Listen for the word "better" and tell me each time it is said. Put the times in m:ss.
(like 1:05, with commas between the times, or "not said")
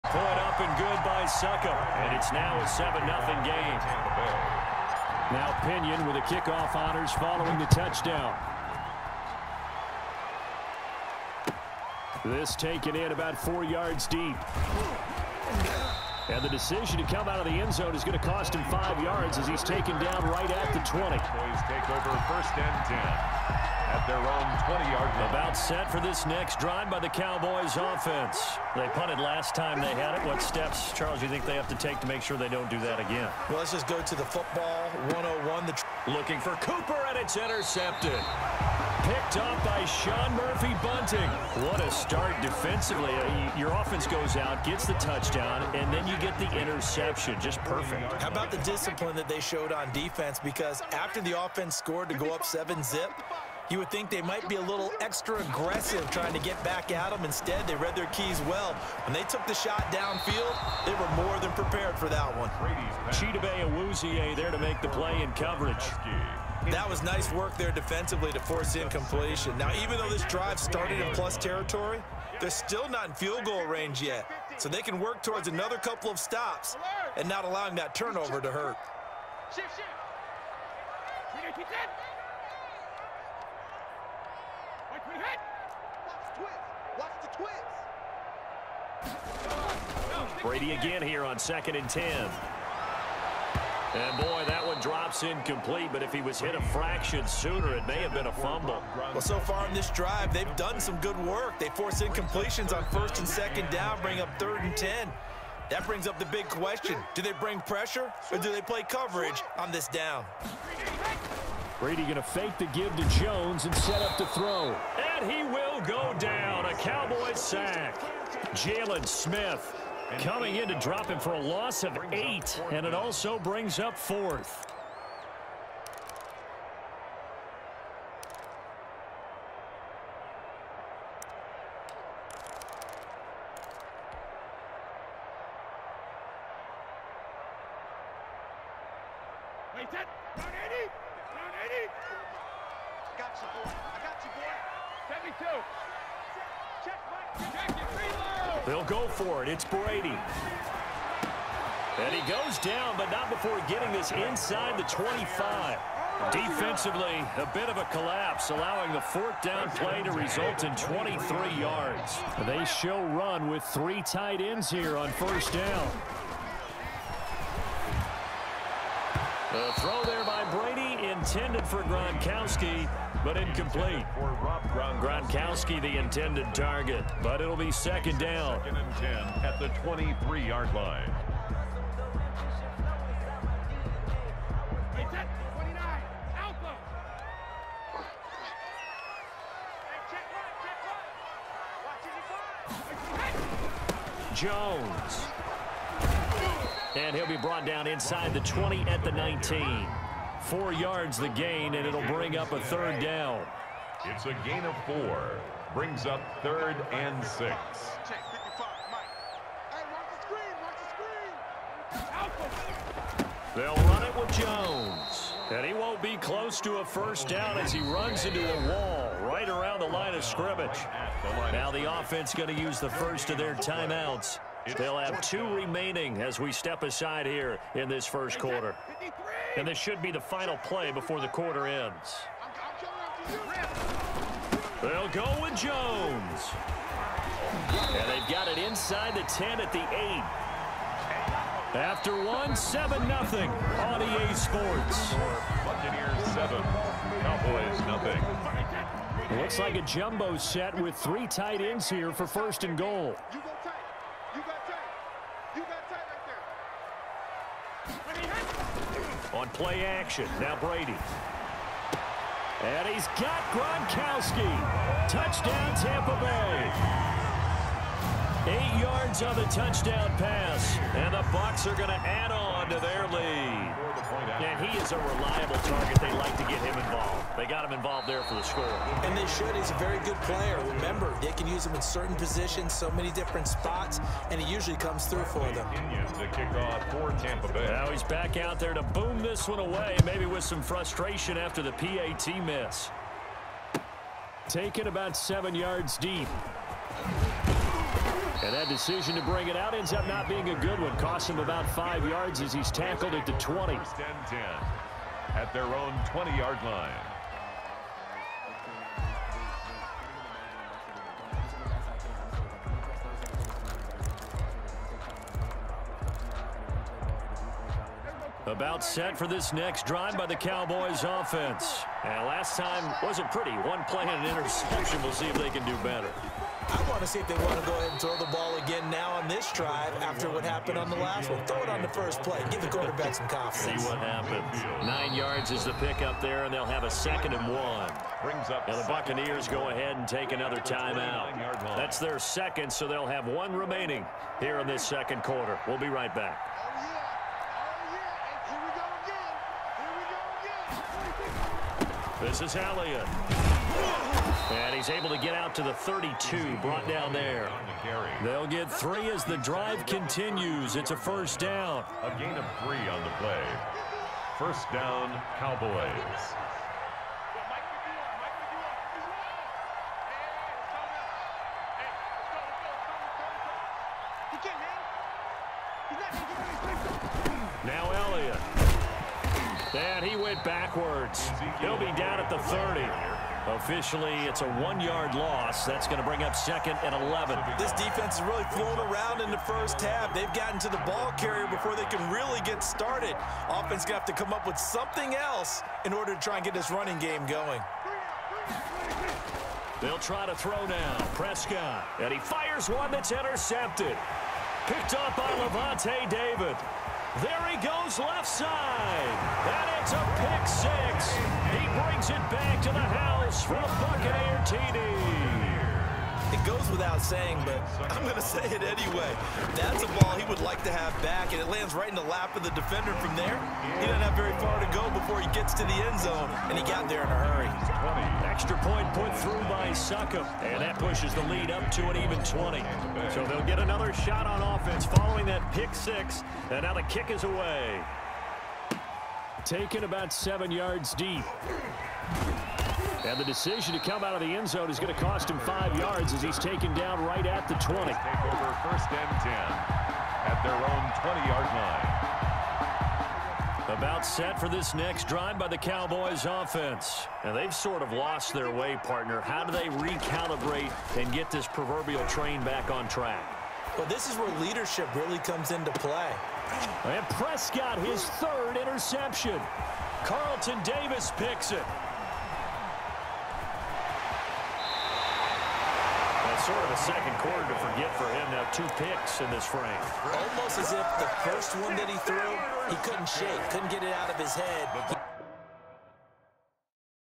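5:25.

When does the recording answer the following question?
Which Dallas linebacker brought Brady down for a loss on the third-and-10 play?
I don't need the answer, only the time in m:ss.
1:58.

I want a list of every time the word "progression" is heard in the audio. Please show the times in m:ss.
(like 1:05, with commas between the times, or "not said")
not said.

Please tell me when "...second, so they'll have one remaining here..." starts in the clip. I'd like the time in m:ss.
5:42.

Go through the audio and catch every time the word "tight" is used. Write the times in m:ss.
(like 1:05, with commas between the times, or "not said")
2:44, 4:11.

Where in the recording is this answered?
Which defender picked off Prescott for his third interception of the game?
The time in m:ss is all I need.
7:50.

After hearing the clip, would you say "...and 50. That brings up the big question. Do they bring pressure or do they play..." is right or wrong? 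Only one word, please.
wrong.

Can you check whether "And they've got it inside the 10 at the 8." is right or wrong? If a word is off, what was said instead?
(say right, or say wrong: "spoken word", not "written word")
right.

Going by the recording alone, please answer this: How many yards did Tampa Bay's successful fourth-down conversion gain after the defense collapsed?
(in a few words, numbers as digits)
23.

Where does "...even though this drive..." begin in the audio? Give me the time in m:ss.
1:09.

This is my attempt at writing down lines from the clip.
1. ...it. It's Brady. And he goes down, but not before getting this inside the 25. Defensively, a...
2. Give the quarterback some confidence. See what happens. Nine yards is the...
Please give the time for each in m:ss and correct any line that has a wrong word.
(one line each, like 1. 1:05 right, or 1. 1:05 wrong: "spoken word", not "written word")
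1. 2:29 right
2. 5:32 right.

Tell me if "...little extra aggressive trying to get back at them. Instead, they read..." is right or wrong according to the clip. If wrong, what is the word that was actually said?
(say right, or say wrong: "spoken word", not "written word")
right.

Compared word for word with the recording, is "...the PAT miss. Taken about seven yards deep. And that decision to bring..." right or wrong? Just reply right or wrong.
right.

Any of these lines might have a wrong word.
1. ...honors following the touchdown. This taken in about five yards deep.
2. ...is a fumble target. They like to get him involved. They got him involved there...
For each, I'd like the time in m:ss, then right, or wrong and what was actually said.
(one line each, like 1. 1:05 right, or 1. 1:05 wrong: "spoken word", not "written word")
1. 0:06 wrong: "four", not "five"
2. 4:34 wrong: "reliable", not "fumble".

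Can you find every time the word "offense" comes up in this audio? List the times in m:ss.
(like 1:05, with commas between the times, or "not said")
0:27, 0:43, 0:51, 3:41, 5:21, 6:33, 7:14, 7:36.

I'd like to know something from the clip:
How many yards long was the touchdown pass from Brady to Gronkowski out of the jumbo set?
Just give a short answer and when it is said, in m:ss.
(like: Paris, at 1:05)
8, at 4:28.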